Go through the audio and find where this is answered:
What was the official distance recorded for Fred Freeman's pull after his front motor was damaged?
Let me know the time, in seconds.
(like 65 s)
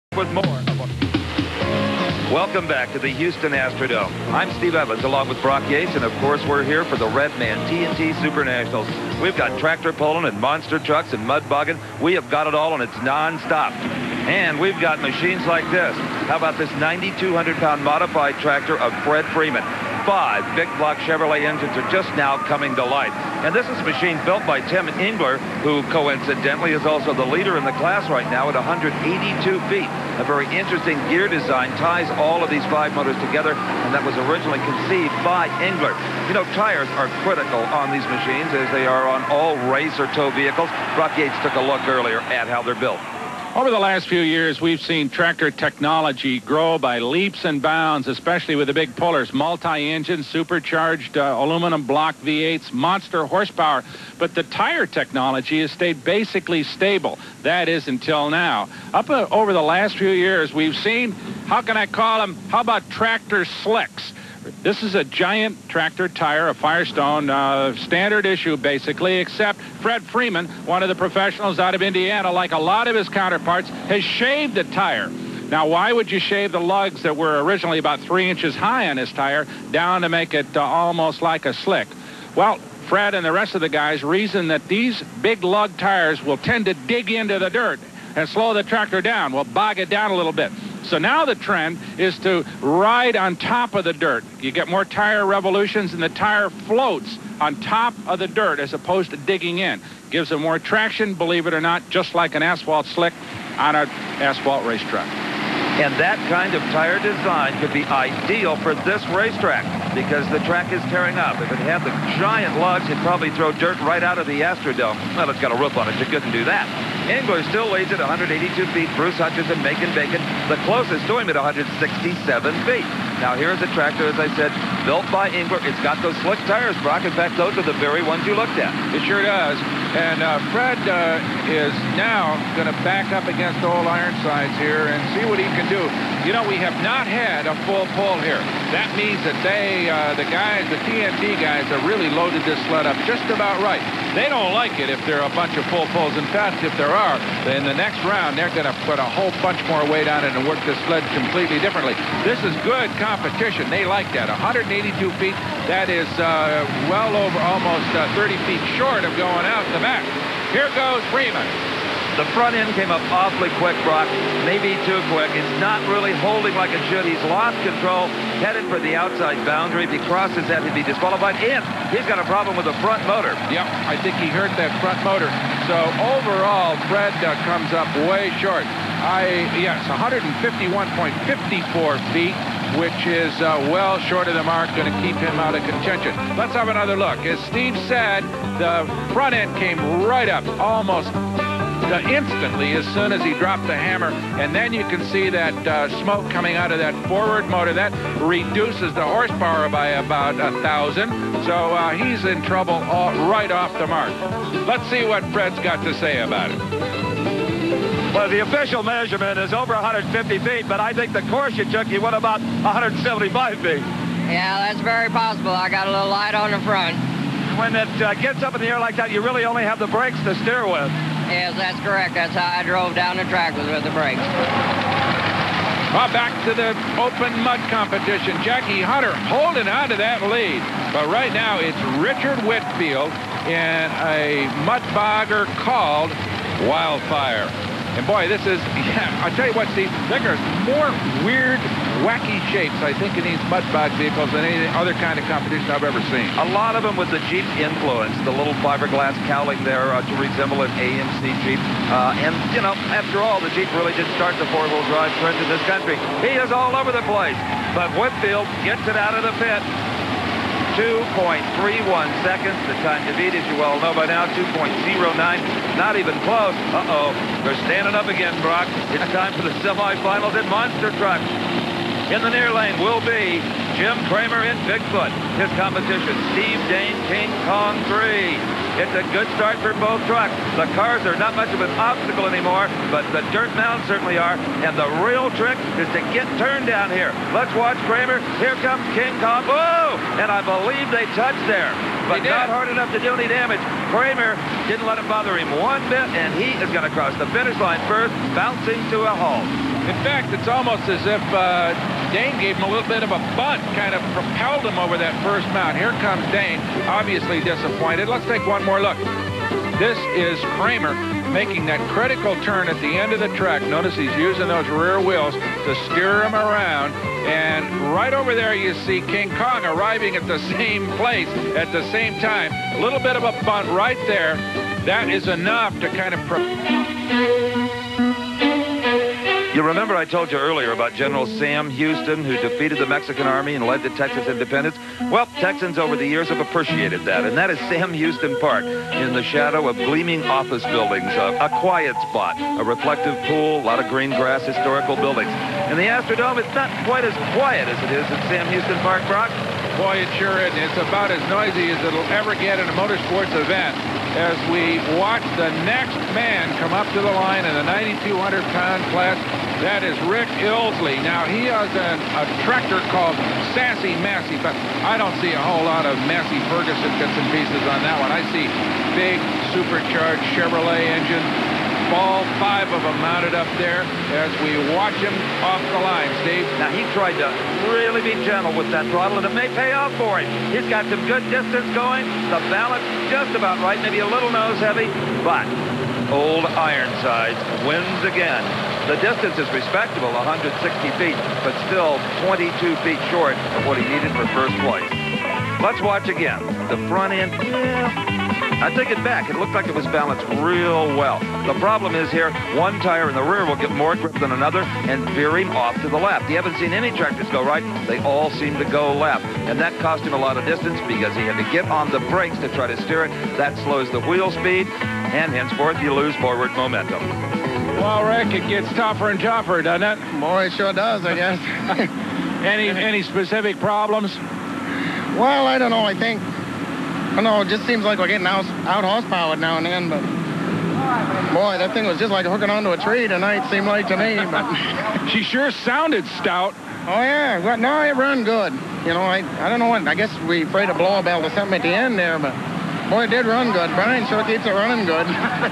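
179 s.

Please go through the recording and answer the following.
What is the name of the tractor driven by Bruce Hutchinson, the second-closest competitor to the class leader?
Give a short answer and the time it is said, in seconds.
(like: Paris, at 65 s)
Macon Bacon, at 119 s.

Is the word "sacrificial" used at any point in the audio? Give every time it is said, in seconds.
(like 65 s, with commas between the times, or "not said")
not said.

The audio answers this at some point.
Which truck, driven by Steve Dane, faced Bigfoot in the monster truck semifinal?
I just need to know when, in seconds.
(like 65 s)
277 s.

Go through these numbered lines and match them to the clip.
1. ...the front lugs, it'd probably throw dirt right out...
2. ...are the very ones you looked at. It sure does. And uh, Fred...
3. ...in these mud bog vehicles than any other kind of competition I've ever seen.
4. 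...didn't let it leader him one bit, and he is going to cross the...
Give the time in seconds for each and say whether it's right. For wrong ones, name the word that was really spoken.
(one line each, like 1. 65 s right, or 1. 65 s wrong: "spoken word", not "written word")
1. 111 s wrong: "giant", not "front"
2. 127 s right
3. 243 s right
4. 294 s wrong: "bother", not "leader".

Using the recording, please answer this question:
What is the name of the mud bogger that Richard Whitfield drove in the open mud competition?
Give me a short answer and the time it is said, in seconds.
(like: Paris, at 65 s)
Wildfire, at 236 s.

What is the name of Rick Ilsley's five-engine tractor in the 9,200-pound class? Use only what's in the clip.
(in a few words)
Sassy Massey.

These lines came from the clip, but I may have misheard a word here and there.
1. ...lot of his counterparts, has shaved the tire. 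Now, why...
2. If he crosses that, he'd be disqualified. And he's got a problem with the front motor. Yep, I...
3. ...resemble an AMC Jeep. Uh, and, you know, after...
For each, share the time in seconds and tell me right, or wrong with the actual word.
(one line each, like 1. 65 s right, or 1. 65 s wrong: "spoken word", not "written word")
1. 72 s right
2. 169 s right
3. 250 s right.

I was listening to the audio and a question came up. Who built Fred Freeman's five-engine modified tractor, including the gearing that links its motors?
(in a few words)
Tim Engler.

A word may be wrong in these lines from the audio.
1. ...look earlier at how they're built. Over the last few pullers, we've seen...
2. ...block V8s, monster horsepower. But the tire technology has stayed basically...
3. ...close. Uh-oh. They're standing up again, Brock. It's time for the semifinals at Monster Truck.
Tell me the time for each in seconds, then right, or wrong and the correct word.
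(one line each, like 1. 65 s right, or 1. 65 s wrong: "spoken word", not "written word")
1. 41 s wrong: "years", not "pullers"
2. 51 s right
3. 266 s right.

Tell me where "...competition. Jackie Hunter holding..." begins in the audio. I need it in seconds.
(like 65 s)
227 s.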